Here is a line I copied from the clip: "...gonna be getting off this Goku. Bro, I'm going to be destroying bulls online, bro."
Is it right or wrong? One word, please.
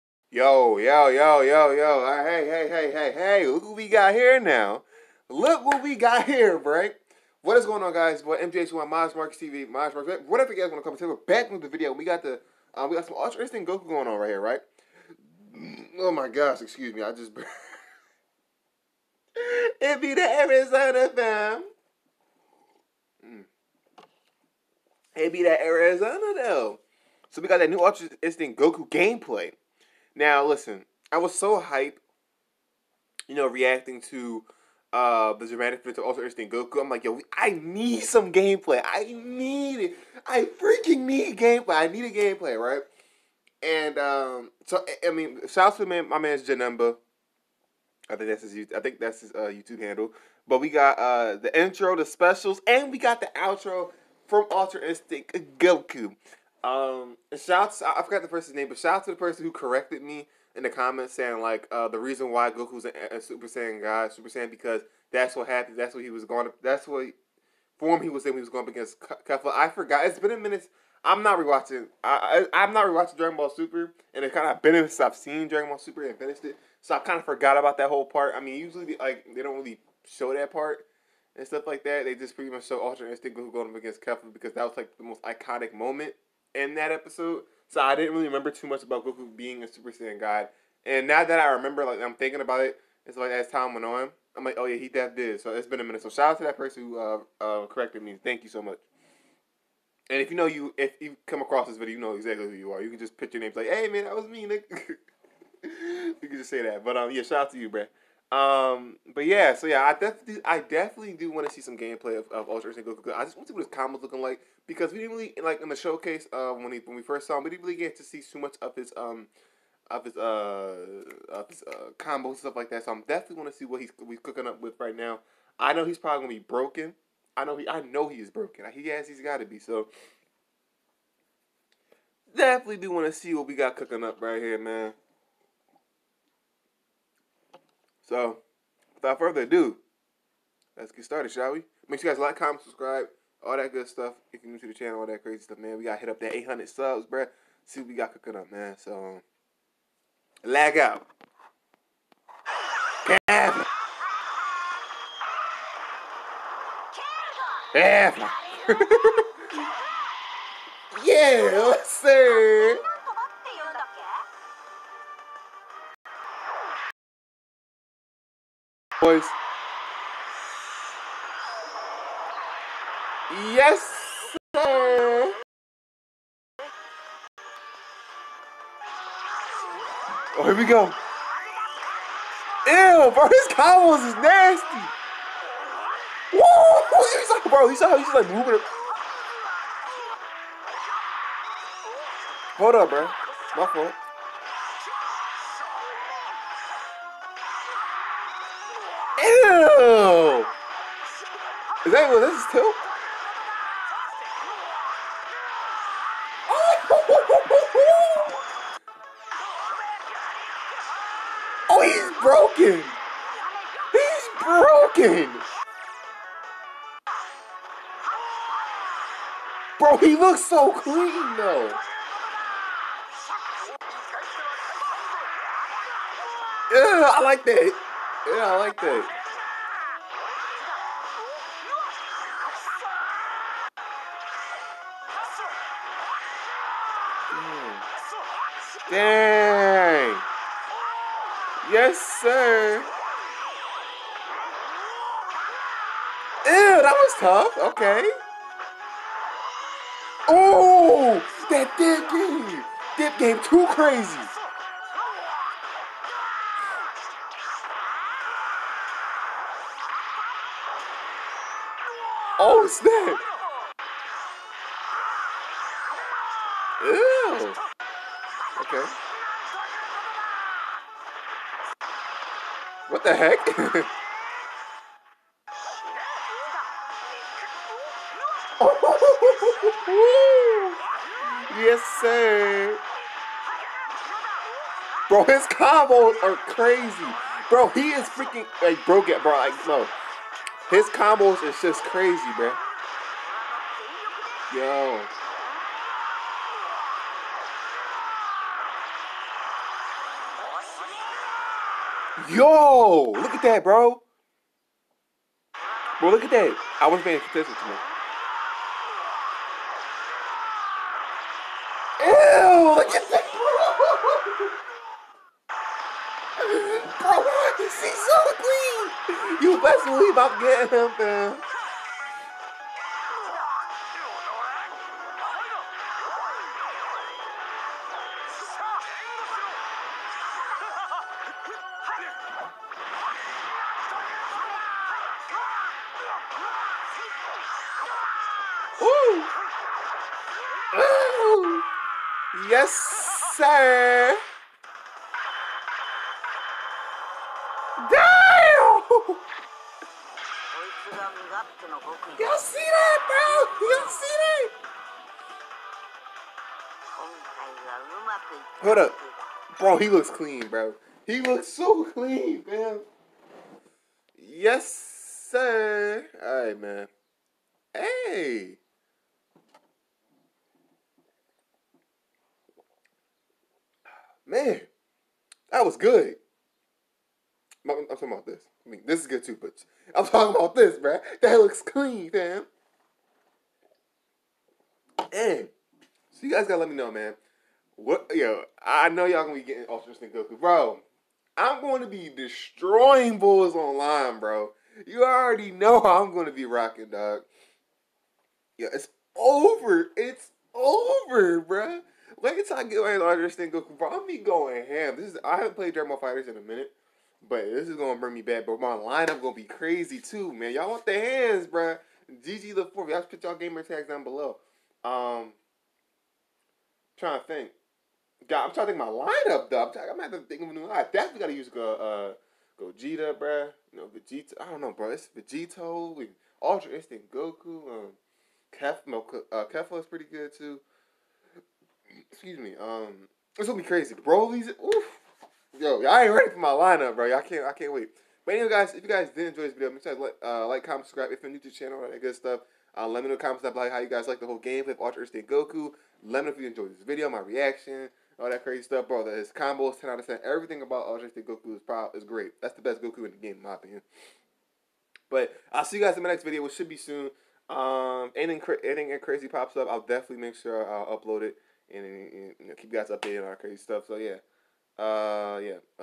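right.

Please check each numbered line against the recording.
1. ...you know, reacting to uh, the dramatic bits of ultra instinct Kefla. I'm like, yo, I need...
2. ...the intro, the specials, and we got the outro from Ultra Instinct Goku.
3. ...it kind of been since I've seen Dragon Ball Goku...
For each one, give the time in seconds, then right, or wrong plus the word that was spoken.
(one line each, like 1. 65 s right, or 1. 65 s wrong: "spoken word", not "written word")
1. 33 s wrong: "Goku", not "Kefla"
2. 51 s right
3. 74 s wrong: "Super", not "Goku".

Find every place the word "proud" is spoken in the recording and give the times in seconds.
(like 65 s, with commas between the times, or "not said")
451 s.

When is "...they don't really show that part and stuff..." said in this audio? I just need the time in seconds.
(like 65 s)
79 s.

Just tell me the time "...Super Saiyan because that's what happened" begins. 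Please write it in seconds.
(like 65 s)
64 s.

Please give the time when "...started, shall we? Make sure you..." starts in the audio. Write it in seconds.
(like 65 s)
141 s.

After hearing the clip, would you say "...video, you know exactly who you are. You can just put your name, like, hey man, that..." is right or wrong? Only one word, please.
right.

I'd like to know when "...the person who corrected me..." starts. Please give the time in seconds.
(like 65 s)
59 s.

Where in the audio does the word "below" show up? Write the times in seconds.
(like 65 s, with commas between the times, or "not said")
414 s, 443 s.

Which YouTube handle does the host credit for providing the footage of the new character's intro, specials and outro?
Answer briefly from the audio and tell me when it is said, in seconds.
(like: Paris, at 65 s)
Janemba, at 46 s.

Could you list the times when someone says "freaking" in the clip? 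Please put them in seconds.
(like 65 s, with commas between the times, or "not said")
40 s, 288 s.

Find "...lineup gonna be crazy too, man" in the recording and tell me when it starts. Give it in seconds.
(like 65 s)
408 s.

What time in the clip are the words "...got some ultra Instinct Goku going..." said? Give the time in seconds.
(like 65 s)
12 s.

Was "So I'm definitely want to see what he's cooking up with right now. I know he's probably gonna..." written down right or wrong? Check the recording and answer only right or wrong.
right.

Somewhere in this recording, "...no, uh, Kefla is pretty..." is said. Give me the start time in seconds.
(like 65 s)
428 s.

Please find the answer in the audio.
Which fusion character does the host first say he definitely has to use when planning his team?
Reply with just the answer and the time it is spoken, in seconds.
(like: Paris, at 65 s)
Gogeta, at 422 s.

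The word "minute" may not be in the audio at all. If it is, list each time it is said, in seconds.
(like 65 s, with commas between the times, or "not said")
70 s, 95 s, 406 s.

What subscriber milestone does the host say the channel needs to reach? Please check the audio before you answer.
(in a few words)
800.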